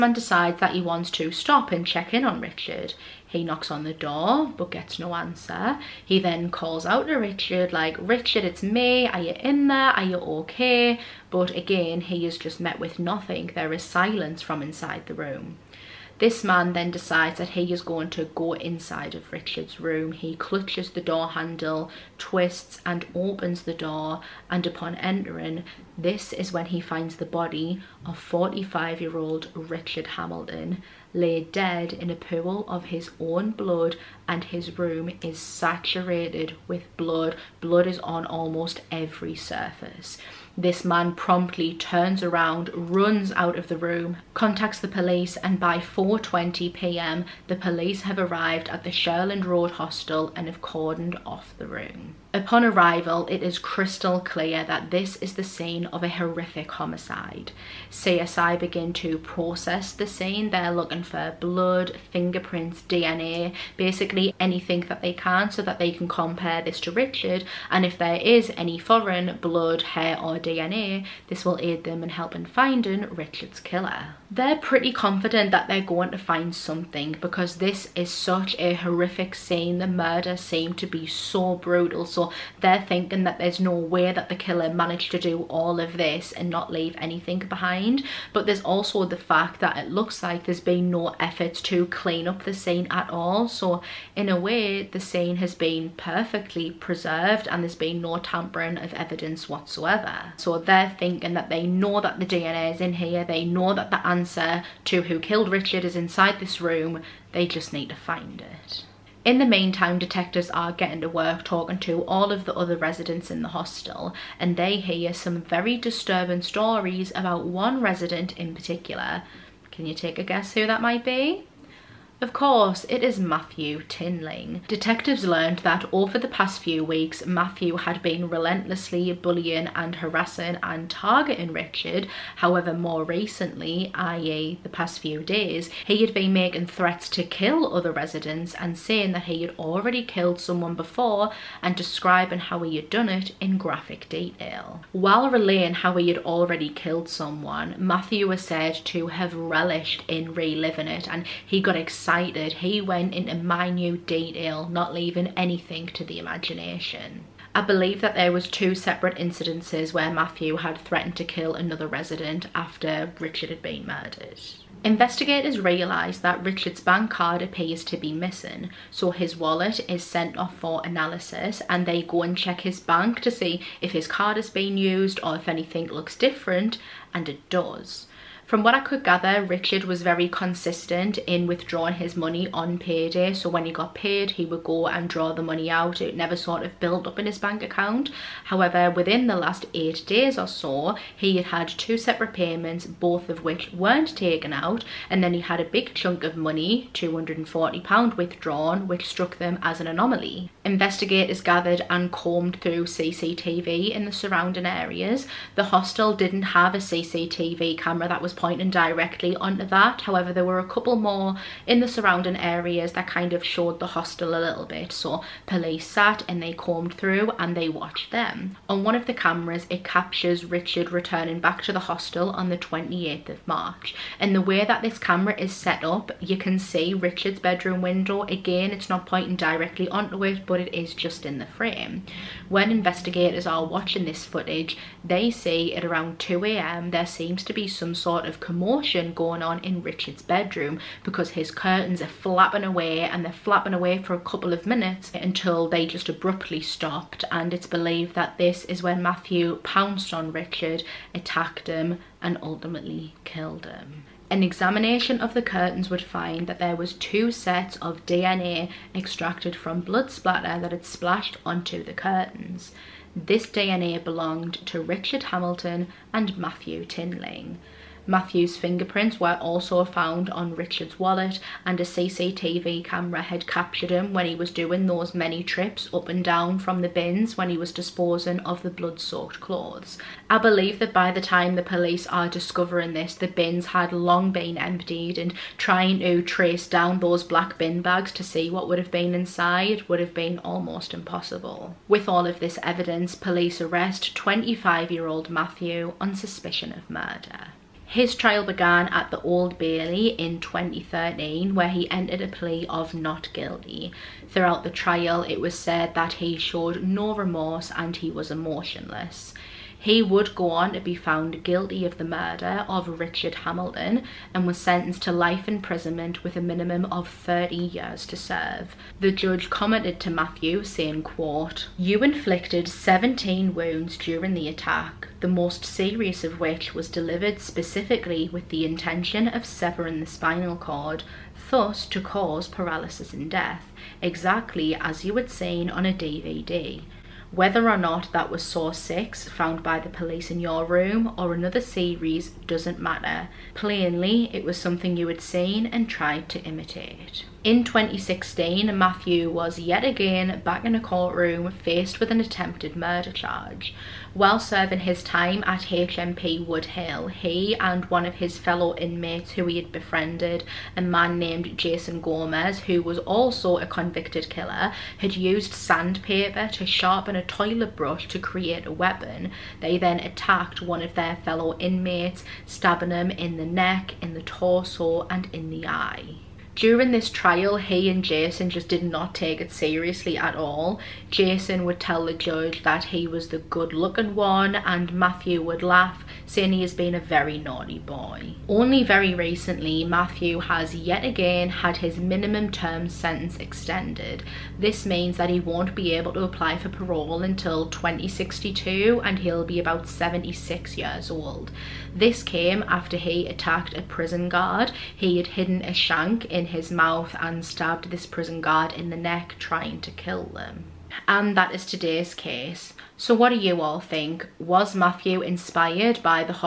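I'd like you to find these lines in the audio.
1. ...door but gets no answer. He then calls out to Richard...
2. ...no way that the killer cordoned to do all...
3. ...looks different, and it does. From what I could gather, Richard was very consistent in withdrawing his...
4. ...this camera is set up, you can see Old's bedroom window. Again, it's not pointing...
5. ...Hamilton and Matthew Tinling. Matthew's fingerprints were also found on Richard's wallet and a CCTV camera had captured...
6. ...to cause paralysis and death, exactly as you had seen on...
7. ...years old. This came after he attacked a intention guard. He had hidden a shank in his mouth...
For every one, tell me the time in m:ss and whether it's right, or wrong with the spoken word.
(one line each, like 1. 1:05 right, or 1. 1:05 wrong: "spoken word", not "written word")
1. 0:03 right
2. 1:23 wrong: "managed", not "cordoned"
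3. 2:55 right
4. 3:44 wrong: "Richard", not "Old"
5. 4:25 right
6. 5:31 right
7. 6:40 wrong: "prison", not "intention".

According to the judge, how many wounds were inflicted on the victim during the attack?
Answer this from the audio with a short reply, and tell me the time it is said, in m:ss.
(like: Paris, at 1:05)
17, at 5:22.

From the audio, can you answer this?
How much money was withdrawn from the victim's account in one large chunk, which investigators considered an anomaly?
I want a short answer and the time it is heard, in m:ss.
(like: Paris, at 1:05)
£240, at 3:16.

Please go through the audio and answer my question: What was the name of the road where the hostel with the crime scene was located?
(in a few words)
Shirland Road.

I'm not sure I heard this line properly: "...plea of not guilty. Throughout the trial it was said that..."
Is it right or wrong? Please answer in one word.
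right.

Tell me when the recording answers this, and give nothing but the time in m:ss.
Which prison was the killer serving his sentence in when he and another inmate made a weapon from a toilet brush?
5:55.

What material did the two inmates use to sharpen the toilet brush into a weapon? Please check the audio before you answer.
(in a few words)
Sandpaper.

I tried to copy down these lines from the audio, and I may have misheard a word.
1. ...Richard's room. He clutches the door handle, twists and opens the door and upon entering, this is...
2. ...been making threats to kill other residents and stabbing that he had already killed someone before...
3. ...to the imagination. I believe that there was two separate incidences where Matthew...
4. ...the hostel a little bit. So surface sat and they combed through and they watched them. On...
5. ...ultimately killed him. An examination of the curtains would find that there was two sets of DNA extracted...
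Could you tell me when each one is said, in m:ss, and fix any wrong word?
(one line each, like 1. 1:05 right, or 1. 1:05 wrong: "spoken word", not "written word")
1. 0:19 right
2. 2:16 wrong: "saying", not "stabbing"
3. 2:35 right
4. 3:33 wrong: "police", not "surface"
5. 4:12 right.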